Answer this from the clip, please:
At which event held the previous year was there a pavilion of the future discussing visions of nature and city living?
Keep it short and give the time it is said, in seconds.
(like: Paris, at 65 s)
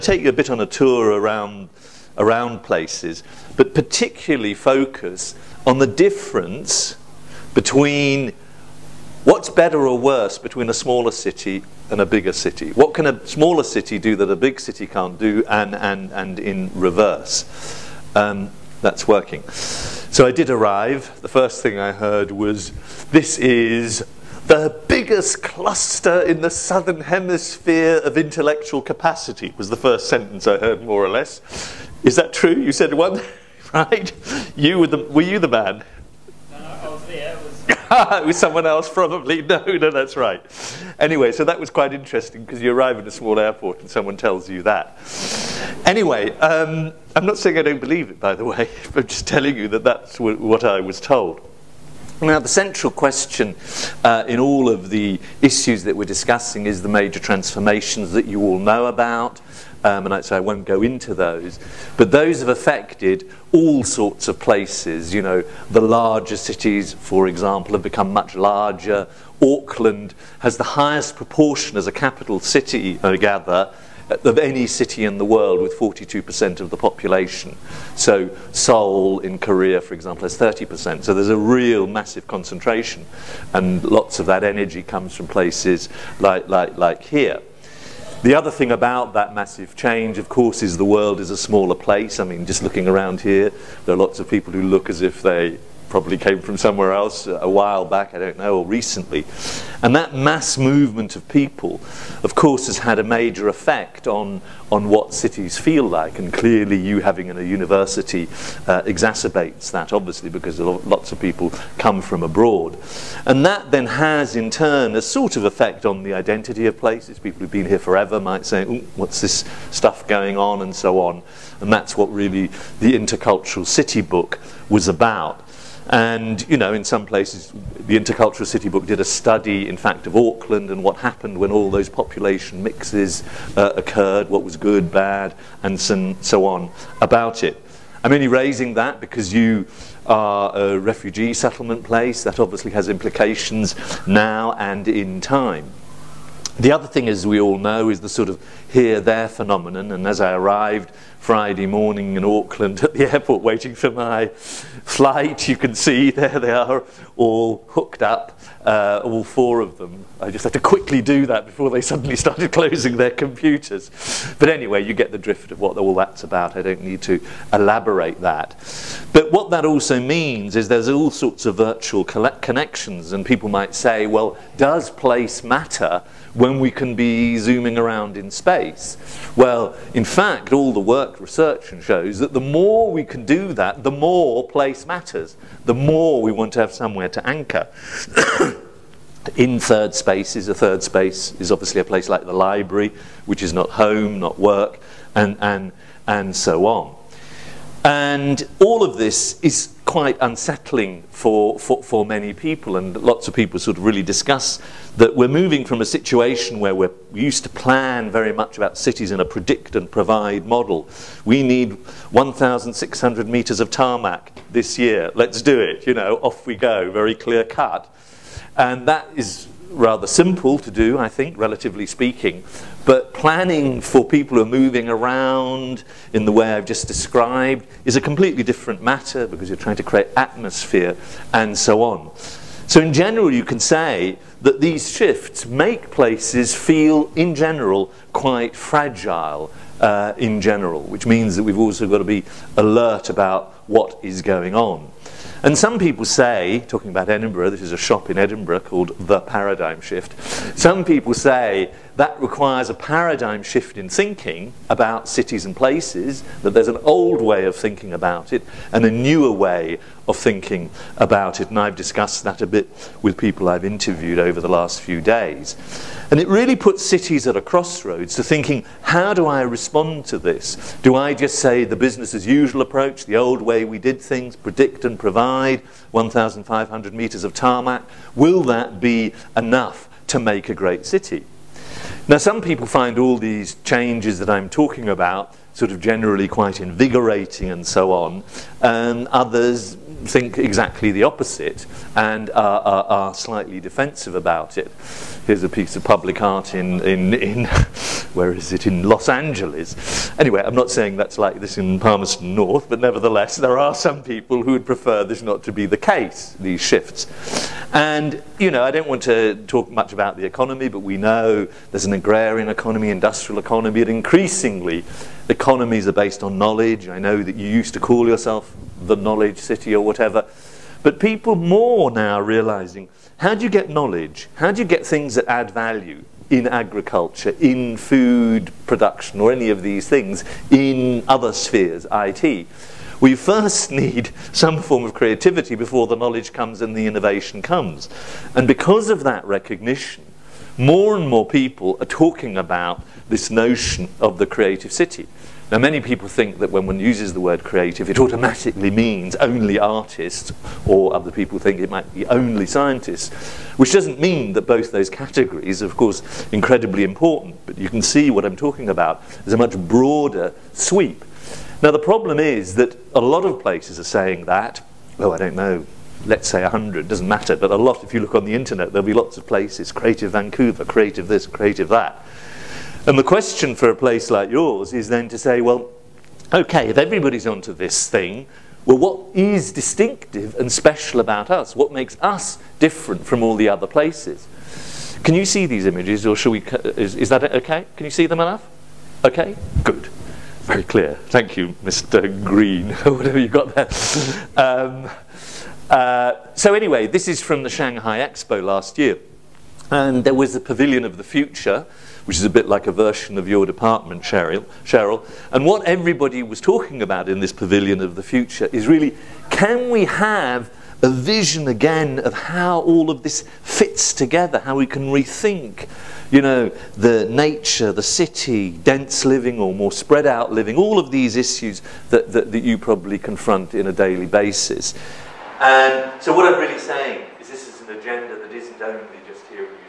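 Shanghai Expo, at 397 s.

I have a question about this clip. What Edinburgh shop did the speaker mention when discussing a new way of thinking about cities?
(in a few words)
The Paradigm Shift.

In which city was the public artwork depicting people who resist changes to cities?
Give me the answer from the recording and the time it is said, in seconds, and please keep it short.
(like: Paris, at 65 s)
Los Angeles, at 298 s.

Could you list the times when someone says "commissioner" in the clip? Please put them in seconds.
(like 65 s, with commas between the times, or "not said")
not said.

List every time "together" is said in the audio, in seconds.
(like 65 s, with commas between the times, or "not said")
413 s.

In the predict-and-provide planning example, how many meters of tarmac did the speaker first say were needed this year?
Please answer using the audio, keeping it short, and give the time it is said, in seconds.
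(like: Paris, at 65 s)
1,600 meters, at 212 s.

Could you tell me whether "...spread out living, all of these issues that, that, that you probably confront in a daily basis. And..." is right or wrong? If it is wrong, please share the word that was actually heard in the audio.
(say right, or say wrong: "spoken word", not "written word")
right.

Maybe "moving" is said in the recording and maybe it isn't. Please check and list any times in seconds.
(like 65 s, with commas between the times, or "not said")
205 s, 224 s.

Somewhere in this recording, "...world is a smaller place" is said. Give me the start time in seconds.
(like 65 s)
90 s.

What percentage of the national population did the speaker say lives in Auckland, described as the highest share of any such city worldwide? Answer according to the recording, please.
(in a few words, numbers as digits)
42%.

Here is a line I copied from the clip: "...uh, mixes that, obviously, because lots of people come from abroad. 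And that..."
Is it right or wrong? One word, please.
wrong.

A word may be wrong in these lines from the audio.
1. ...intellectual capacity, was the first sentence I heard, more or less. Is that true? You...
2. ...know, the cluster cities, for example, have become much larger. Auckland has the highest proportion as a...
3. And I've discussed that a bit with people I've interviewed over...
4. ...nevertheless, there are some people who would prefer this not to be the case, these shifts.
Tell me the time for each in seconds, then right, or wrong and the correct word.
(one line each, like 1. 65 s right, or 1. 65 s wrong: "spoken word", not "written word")
1. 28 s right
2. 65 s wrong: "larger", not "cluster"
3. 261 s right
4. 302 s right.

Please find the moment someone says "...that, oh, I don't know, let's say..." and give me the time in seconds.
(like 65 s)
364 s.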